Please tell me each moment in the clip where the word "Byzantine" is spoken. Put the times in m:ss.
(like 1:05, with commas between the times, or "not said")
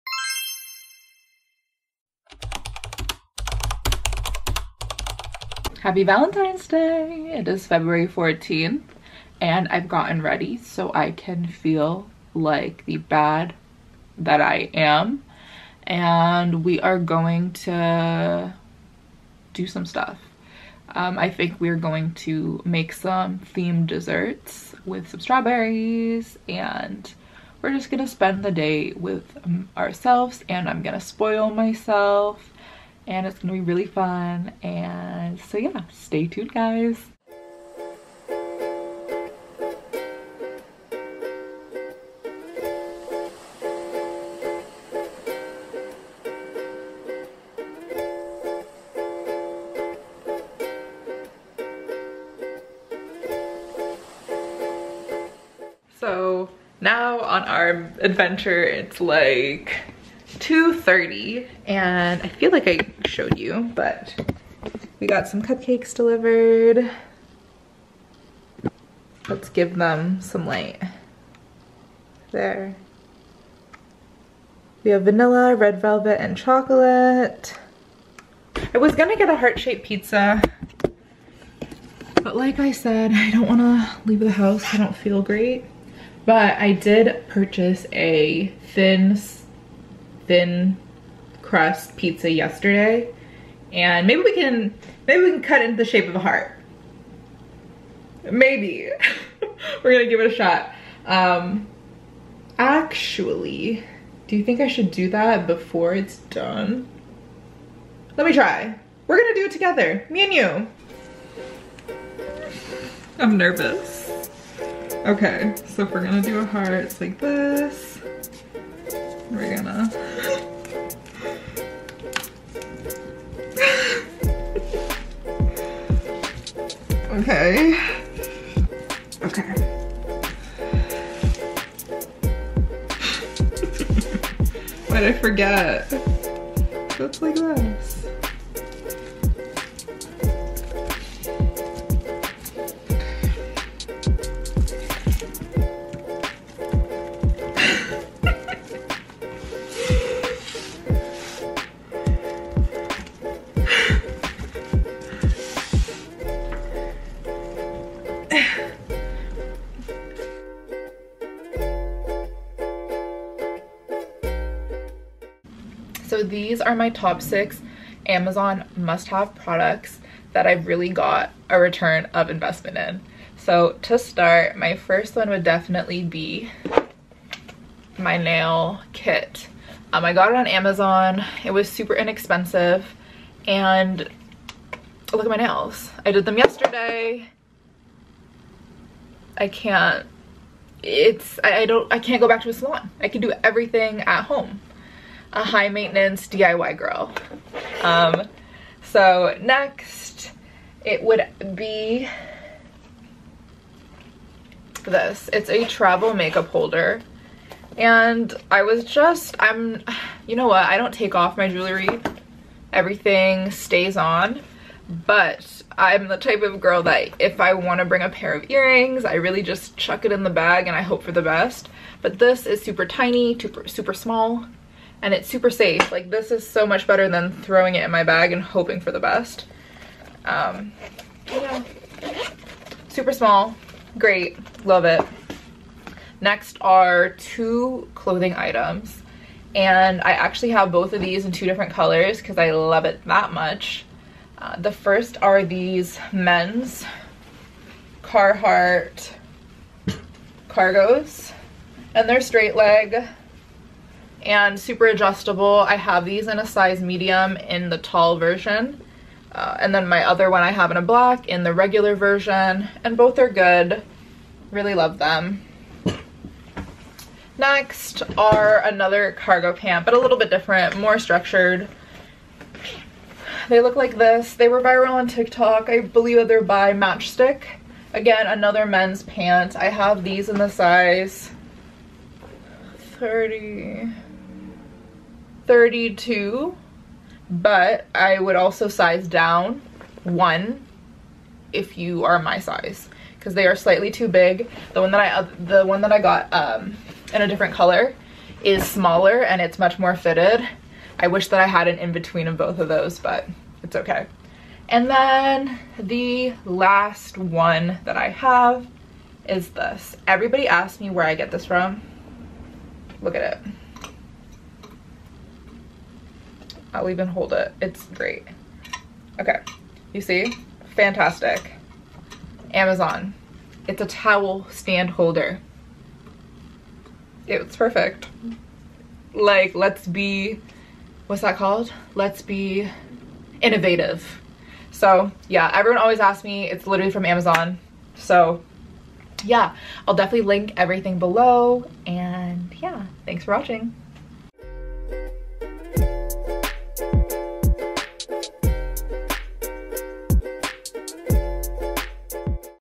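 not said.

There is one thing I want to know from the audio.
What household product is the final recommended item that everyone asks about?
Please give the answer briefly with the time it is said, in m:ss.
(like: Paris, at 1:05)
towel stand holder, at 5:23.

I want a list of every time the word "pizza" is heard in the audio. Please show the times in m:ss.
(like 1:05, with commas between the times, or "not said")
1:19, 1:31.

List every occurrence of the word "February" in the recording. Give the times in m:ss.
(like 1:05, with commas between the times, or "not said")
0:07.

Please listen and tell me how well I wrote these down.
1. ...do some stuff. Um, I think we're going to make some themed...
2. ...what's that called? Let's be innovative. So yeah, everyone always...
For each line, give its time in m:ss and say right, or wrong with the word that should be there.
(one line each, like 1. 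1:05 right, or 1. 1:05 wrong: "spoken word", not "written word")
1. 0:19 right
2. 5:31 right.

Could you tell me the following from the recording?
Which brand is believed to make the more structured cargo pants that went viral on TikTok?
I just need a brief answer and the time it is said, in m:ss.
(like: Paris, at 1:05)
Matchstick, at 4:36.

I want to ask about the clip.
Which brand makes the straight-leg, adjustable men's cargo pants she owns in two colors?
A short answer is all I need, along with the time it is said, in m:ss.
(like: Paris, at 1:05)
Carhartt, at 4:08.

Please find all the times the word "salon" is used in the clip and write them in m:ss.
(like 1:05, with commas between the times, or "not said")
3:12.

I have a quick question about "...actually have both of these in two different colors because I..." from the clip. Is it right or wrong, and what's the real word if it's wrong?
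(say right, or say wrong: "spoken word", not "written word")
right.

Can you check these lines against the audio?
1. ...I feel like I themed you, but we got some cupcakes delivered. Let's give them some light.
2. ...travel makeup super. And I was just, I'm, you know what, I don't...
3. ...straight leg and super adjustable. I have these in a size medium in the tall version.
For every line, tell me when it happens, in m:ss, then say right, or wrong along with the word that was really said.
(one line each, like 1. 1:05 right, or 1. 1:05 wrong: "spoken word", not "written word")
1. 1:02 wrong: "showed", not "themed"
2. 3:25 wrong: "holder", not "super"
3. 4:12 right.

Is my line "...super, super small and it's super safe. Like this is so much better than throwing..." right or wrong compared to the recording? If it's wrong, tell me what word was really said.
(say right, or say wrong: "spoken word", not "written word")
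right.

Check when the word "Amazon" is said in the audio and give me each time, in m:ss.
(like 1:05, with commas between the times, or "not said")
2:48, 3:00, 5:22, 5:37.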